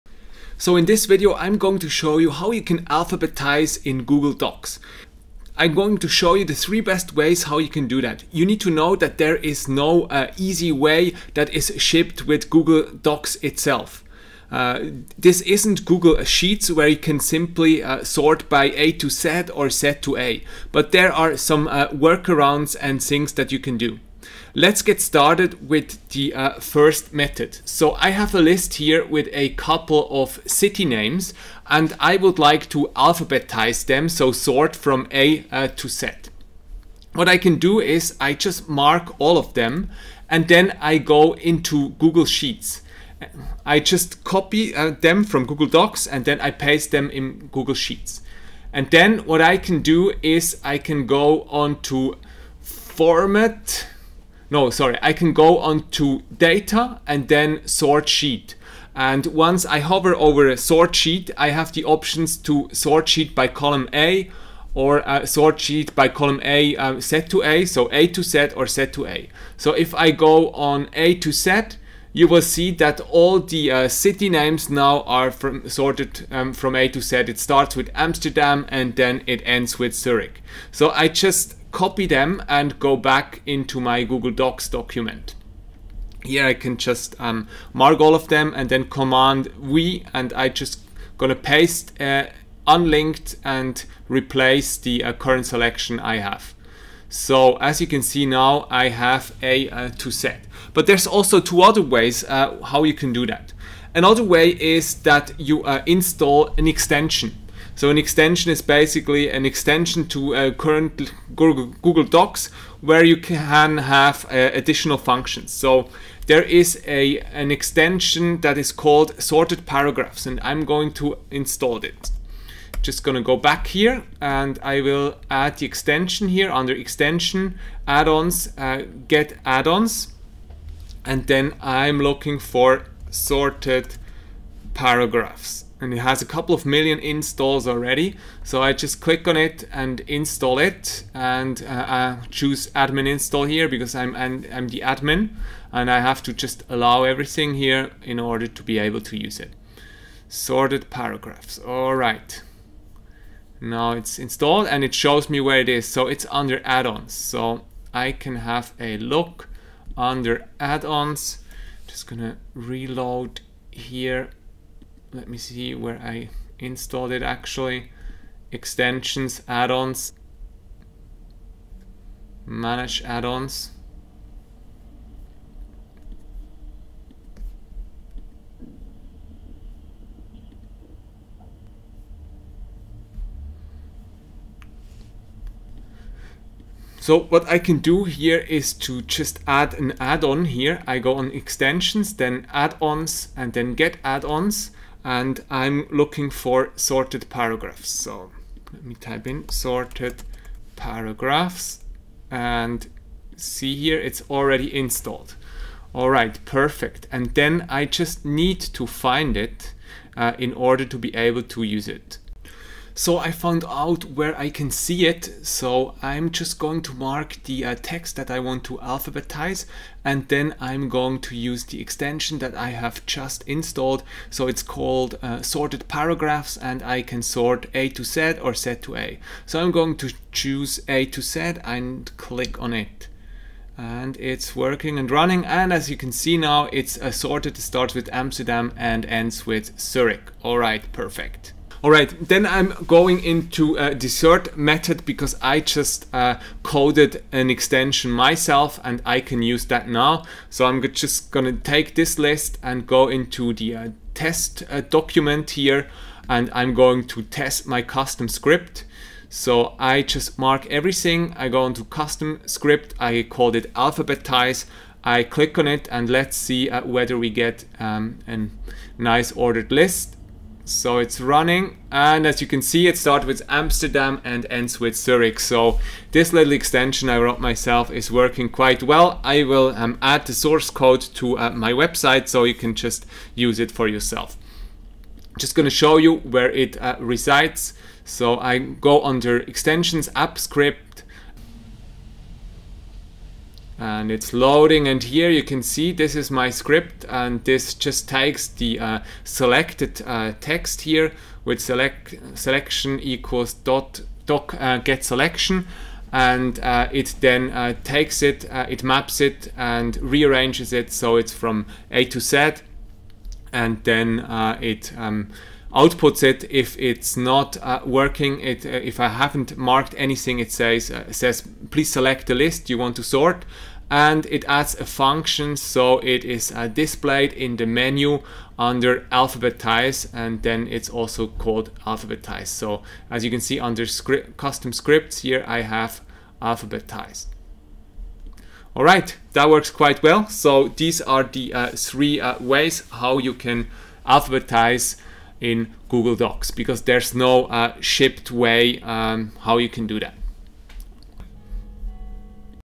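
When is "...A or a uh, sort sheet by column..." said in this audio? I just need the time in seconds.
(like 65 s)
63 s.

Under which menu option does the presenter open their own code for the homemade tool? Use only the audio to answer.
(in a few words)
app script.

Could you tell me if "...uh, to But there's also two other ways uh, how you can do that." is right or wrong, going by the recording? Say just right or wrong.
right.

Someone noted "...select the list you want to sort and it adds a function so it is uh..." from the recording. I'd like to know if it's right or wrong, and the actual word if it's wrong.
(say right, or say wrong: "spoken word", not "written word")
right.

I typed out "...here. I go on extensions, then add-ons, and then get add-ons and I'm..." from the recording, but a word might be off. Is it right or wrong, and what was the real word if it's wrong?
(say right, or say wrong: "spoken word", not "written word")
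right.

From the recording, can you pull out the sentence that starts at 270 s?
So it's running and as you can see it starts with Amsterdam and ends with Zurich.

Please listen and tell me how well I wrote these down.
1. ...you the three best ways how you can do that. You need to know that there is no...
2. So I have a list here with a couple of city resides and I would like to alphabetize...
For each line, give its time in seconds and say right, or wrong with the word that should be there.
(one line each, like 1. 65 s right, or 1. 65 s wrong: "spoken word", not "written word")
1. 6 s right
2. 27 s wrong: "names", not "resides".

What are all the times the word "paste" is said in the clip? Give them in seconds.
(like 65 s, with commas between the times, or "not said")
46 s, 91 s.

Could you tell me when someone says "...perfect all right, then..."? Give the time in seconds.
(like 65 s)
240 s.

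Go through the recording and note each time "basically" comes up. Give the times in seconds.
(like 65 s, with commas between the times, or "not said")
108 s.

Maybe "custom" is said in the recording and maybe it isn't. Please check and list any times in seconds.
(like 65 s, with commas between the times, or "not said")
257 s, 261 s, 334 s.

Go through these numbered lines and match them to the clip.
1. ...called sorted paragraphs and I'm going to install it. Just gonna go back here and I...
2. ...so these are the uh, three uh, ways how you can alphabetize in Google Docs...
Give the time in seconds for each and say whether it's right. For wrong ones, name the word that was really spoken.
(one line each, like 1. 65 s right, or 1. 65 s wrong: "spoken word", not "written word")
1. 118 s right
2. 340 s right.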